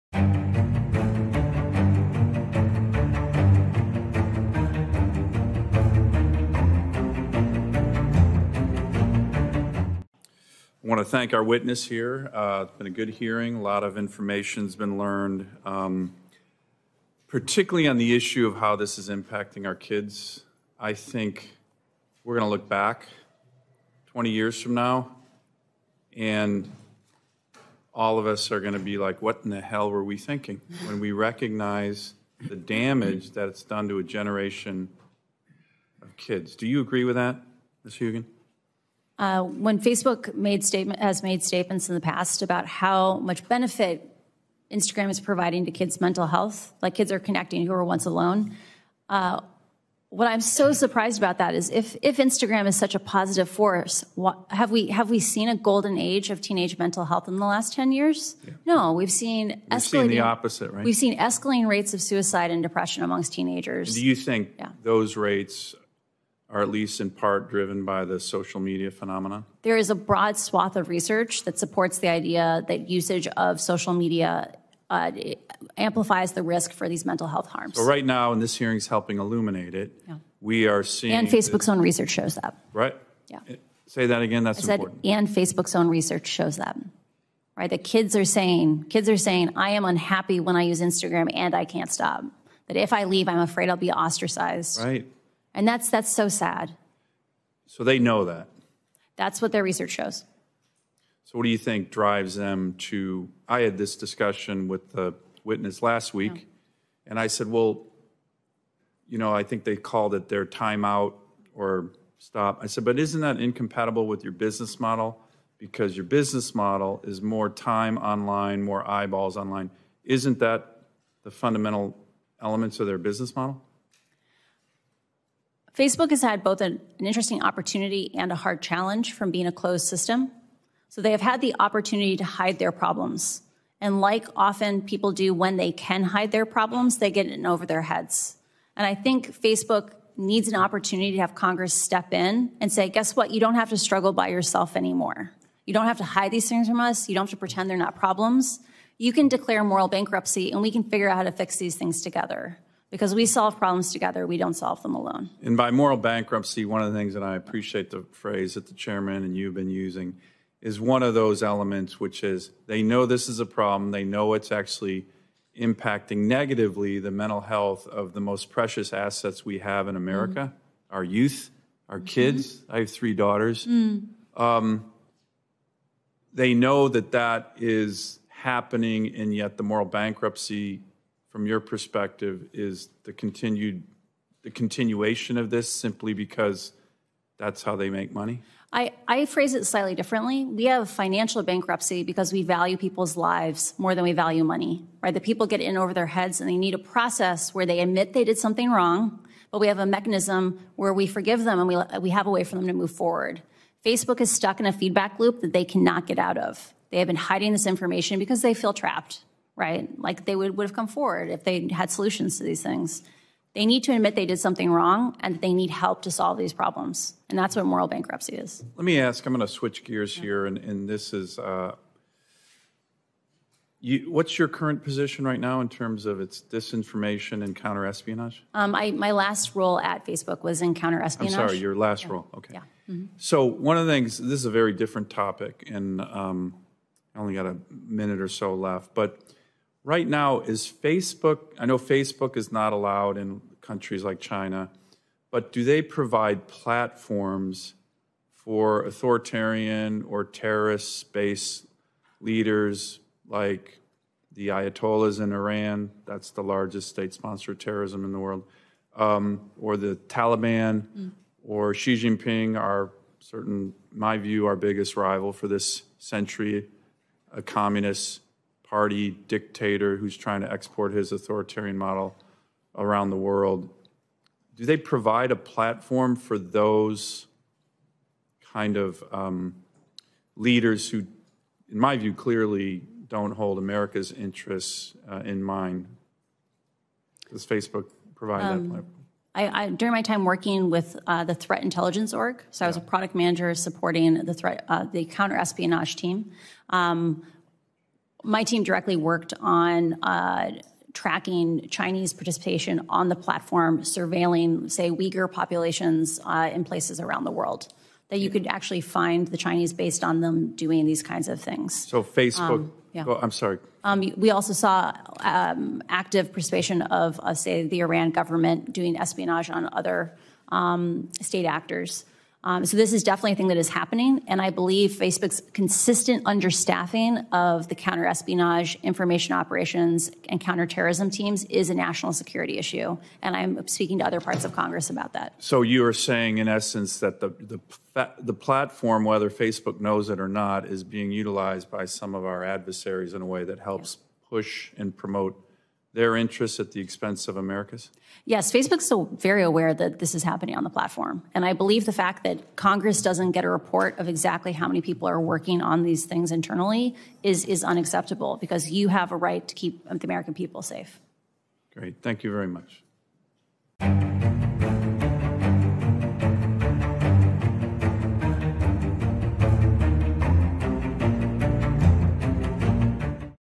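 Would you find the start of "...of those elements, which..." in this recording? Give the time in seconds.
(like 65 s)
161 s.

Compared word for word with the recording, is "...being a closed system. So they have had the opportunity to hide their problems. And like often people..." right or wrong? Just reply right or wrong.
right.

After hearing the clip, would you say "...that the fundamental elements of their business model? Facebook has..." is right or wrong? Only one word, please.
right.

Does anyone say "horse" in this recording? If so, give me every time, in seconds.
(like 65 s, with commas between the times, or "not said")
not said.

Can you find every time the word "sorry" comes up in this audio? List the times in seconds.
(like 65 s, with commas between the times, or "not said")
231 s, 313 s.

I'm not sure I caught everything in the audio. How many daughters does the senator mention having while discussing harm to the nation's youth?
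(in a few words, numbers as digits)
3.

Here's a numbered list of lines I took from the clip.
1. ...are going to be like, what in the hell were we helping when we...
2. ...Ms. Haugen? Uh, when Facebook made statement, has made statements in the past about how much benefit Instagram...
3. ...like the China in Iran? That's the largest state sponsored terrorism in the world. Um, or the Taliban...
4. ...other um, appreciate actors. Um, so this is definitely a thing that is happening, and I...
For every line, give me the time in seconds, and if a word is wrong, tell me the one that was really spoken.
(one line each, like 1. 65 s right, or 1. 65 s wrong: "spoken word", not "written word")
1. 28 s wrong: "thinking", not "helping"
2. 37 s right
3. 253 s wrong: "Ayatollahs", not "China"
4. 319 s wrong: "state", not "appreciate".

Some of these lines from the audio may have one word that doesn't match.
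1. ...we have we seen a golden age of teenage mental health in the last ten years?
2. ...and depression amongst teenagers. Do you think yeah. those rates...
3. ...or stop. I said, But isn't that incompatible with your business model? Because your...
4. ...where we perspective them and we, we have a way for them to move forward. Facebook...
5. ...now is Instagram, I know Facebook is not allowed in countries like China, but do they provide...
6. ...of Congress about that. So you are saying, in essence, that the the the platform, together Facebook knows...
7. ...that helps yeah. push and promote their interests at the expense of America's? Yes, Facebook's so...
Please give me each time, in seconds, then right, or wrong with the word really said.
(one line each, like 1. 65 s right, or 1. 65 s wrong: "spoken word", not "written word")
1. 54 s right
2. 62 s right
3. 111 s right
4. 200 s wrong: "forgive", not "perspective"
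5. 240 s wrong: "Facebook", not "Instagram"
6. 334 s wrong: "whether", not "together"
7. 343 s right.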